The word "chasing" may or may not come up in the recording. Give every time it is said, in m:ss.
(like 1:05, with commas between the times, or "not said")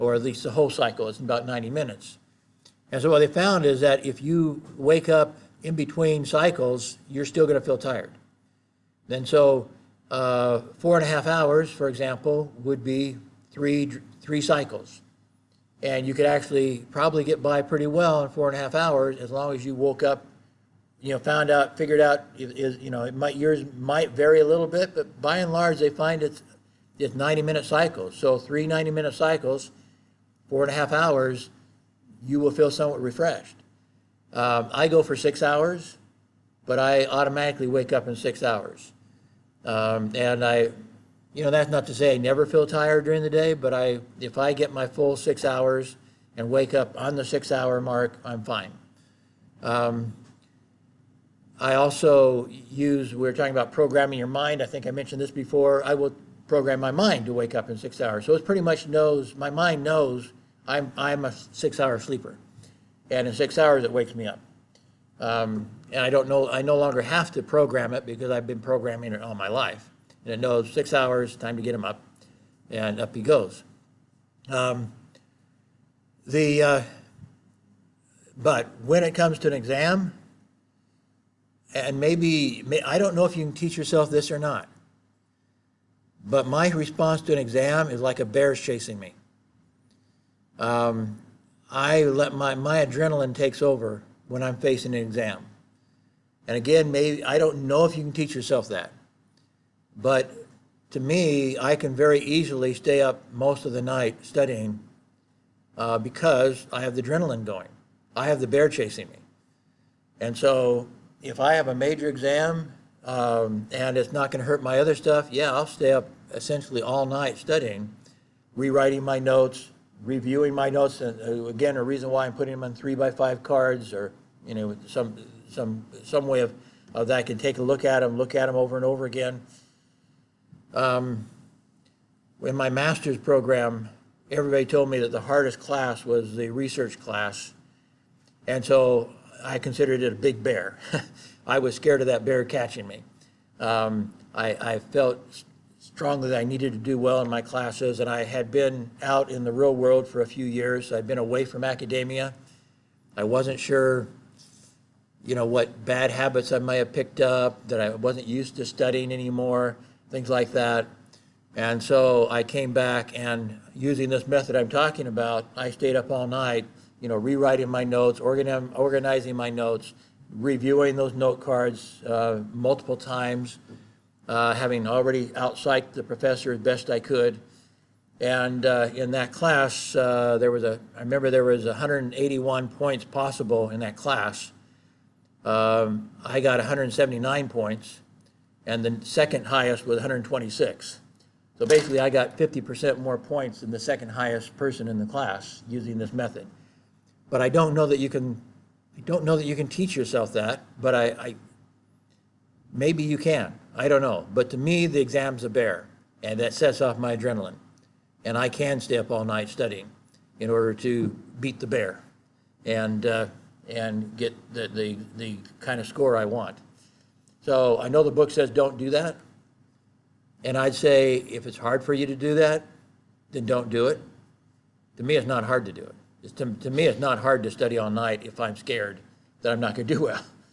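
1:28, 1:48.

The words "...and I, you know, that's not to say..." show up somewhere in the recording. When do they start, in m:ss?
0:40.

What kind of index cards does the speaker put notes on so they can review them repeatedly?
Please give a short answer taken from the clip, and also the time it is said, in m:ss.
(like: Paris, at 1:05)
3 by 5 cards, at 2:02.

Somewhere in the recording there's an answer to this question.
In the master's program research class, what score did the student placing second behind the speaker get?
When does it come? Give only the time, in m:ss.
3:09.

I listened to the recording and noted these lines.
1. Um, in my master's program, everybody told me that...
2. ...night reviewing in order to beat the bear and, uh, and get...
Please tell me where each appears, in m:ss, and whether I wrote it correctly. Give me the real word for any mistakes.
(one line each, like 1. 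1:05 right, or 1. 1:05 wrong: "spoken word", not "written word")
1. 2:10 right
2. 3:29 wrong: "studying", not "reviewing".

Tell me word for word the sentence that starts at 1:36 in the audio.
And again, maybe I don't know if you can teach yourself that.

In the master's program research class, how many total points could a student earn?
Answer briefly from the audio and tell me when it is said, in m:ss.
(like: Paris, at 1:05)
181, at 3:01.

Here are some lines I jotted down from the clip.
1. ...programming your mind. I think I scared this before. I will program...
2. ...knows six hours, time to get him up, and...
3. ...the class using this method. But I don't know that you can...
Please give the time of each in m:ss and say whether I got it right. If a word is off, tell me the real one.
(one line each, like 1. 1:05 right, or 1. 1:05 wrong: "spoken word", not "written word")
1. 0:53 wrong: "mentioned", not "scared"
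2. 1:10 right
3. 3:14 right.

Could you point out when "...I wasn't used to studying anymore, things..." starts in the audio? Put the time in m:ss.
2:37.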